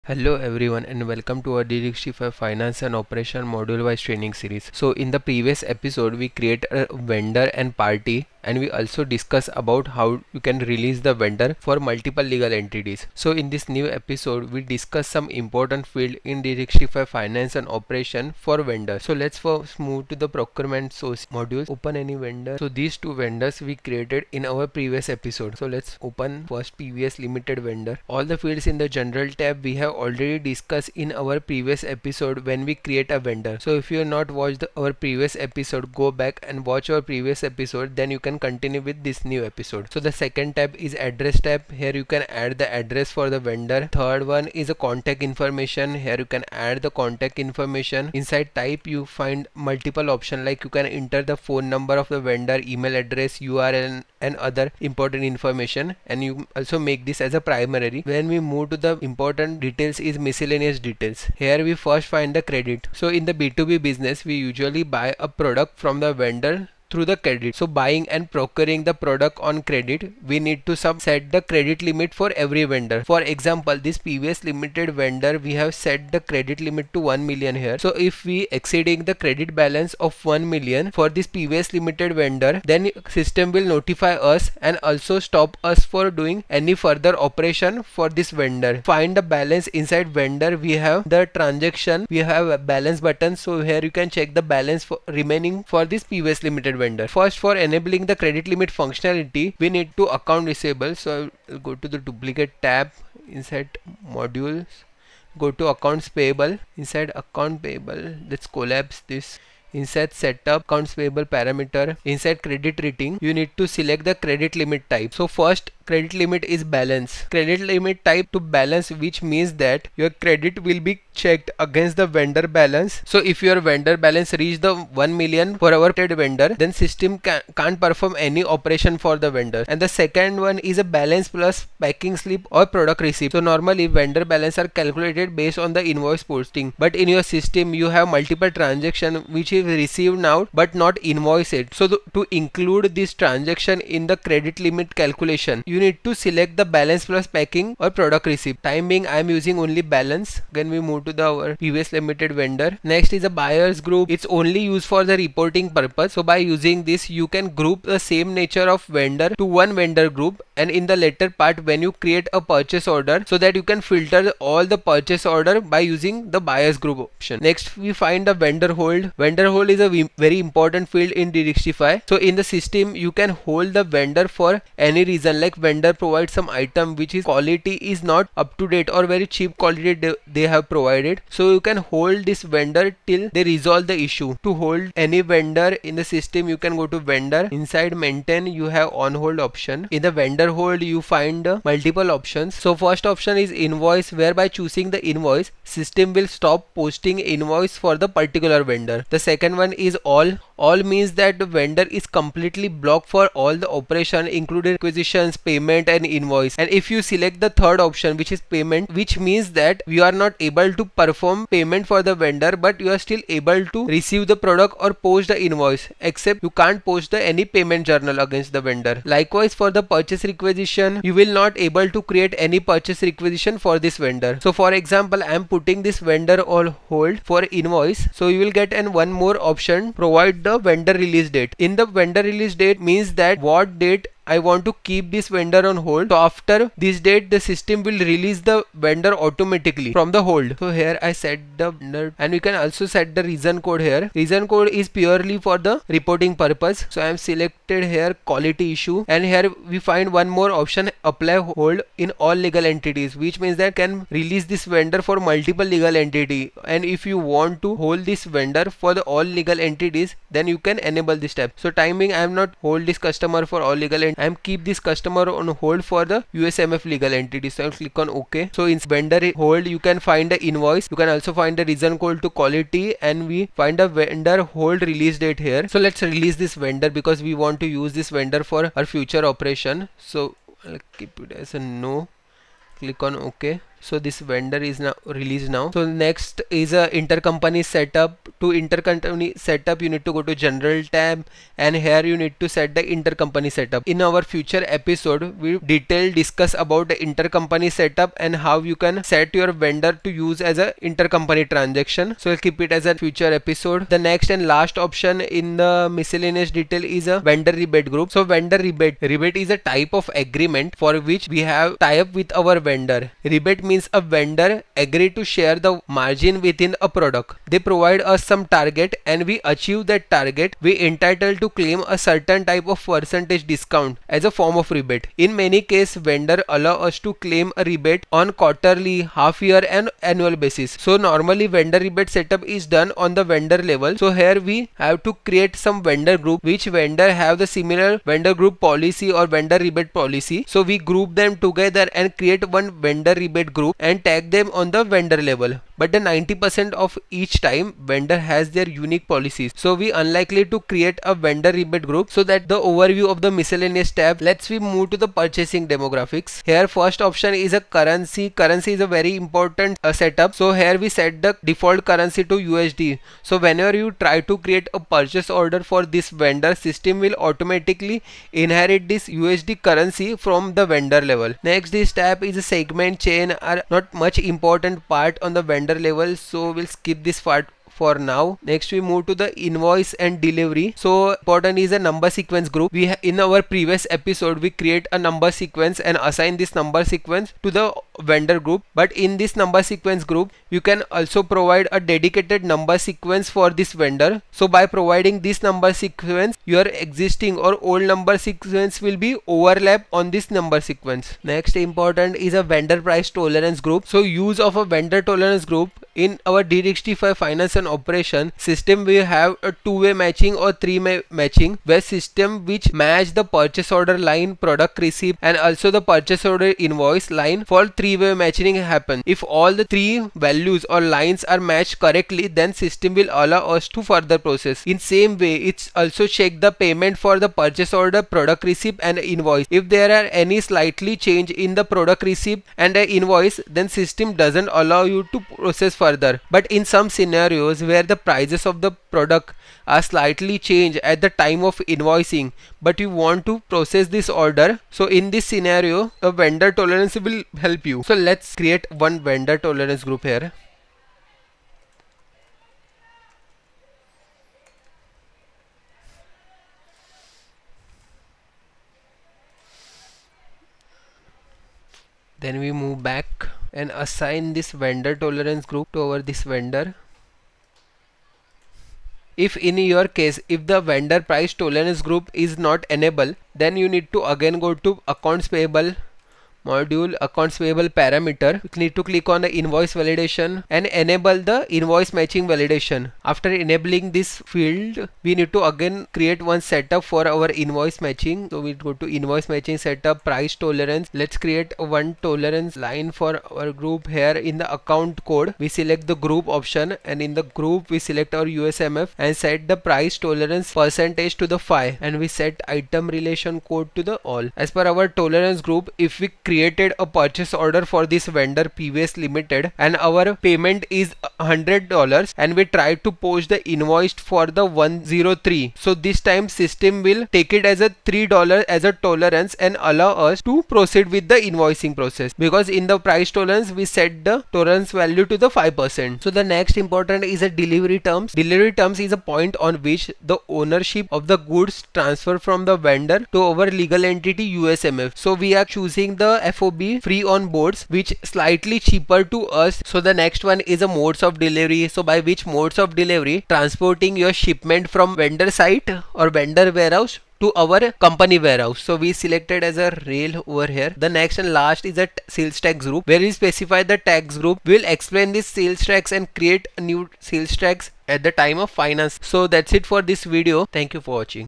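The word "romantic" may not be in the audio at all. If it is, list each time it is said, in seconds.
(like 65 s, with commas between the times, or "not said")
not said.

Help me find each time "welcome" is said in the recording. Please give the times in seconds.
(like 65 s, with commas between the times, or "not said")
1 s.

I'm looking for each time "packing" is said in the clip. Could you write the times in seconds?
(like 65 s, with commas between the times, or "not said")
131 s, 147 s.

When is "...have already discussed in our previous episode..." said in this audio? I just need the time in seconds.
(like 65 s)
29 s.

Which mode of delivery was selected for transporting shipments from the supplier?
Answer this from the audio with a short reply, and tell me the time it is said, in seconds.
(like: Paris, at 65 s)
rail, at 549 s.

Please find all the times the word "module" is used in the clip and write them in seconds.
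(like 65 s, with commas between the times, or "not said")
3 s, 21 s, 104 s, 476 s.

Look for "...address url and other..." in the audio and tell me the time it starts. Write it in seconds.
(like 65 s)
52 s.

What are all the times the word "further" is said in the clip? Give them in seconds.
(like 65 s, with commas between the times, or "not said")
86 s, 423 s, 435 s.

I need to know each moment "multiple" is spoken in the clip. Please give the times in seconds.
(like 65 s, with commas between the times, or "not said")
11 s, 49 s, 138 s, 191 s, 255 s.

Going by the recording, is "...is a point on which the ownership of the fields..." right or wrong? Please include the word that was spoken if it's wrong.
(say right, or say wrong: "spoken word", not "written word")
wrong: "goods", not "fields".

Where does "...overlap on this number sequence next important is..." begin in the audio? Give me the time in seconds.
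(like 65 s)
399 s.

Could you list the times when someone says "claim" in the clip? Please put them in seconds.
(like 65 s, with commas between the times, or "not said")
321 s, 327 s.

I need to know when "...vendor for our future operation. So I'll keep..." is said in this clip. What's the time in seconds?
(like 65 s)
278 s.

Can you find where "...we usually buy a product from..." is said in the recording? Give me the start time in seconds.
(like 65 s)
64 s.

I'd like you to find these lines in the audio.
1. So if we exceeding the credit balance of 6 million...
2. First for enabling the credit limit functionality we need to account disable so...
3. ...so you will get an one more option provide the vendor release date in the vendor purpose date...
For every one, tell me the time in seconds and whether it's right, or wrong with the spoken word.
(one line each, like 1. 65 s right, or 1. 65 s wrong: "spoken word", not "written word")
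1. 77 s wrong: "1", not "6"
2. 97 s right
3. 228 s wrong: "release", not "purpose".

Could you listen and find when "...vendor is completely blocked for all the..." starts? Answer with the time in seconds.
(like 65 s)
201 s.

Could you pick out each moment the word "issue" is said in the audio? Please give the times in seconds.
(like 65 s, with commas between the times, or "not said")
184 s, 248 s.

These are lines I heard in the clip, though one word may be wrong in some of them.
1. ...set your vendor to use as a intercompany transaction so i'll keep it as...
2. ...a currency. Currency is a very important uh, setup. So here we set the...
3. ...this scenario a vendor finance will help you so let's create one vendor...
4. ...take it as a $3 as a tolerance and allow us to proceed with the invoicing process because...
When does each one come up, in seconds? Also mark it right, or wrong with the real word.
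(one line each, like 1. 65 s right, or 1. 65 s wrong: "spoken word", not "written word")
1. 299 s right
2. 357 s right
3. 445 s wrong: "tolerance", not "finance"
4. 517 s right.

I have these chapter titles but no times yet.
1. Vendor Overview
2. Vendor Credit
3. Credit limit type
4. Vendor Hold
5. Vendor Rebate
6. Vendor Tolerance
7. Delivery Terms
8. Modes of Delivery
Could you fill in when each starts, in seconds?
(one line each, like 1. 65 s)
1. 20 s
2. 61 s
3. 112 s
4. 167 s
5. 307 s
6. 401 s
7. 526 s
8. 540 s.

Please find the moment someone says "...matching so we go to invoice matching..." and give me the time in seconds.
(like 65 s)
487 s.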